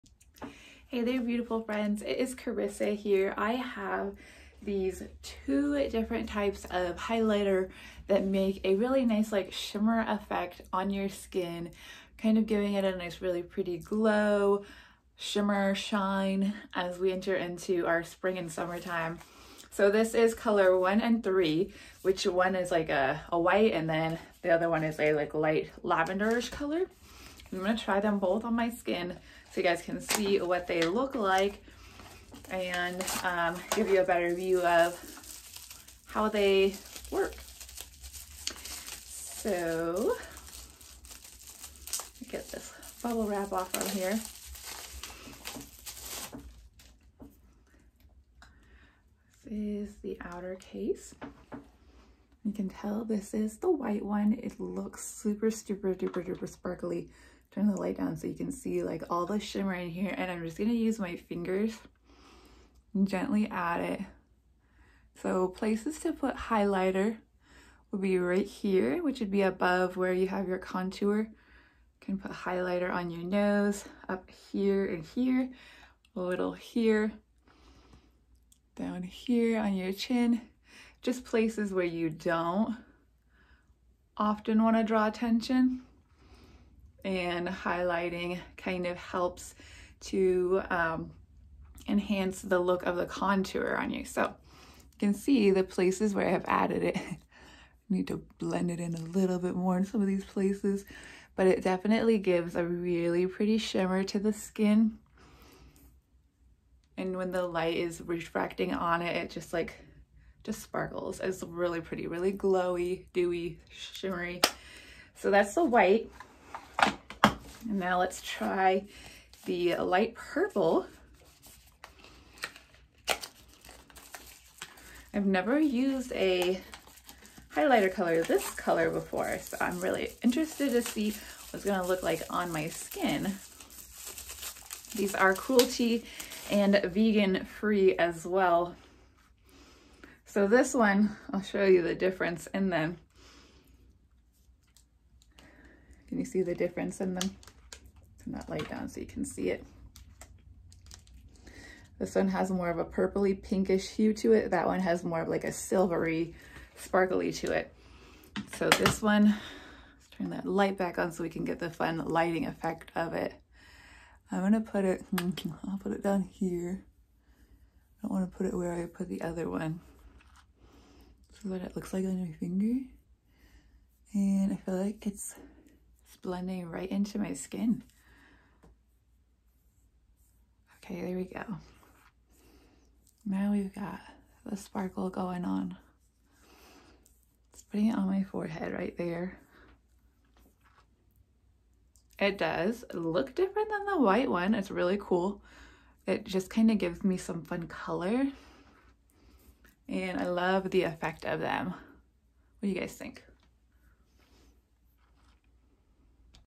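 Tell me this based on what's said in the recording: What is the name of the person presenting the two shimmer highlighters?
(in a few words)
Karissa.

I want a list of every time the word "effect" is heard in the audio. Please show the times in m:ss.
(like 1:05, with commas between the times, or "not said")
0:10, 2:42, 3:20.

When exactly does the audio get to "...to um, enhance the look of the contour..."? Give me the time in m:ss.
1:29.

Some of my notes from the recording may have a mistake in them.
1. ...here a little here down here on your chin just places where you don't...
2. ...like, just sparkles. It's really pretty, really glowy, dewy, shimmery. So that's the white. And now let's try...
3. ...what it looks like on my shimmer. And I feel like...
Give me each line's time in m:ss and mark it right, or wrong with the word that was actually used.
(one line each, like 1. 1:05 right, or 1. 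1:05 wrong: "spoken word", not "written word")
1. 1:15 right
2. 1:49 right
3. 2:51 wrong: "finger", not "shimmer".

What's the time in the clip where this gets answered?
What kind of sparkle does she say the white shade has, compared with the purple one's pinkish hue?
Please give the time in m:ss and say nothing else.
2:35.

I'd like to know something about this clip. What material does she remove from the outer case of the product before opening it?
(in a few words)
Bubble wrap.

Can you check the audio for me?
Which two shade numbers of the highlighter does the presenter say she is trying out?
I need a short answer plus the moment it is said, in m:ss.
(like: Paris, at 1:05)
1 and 3, at 0:20.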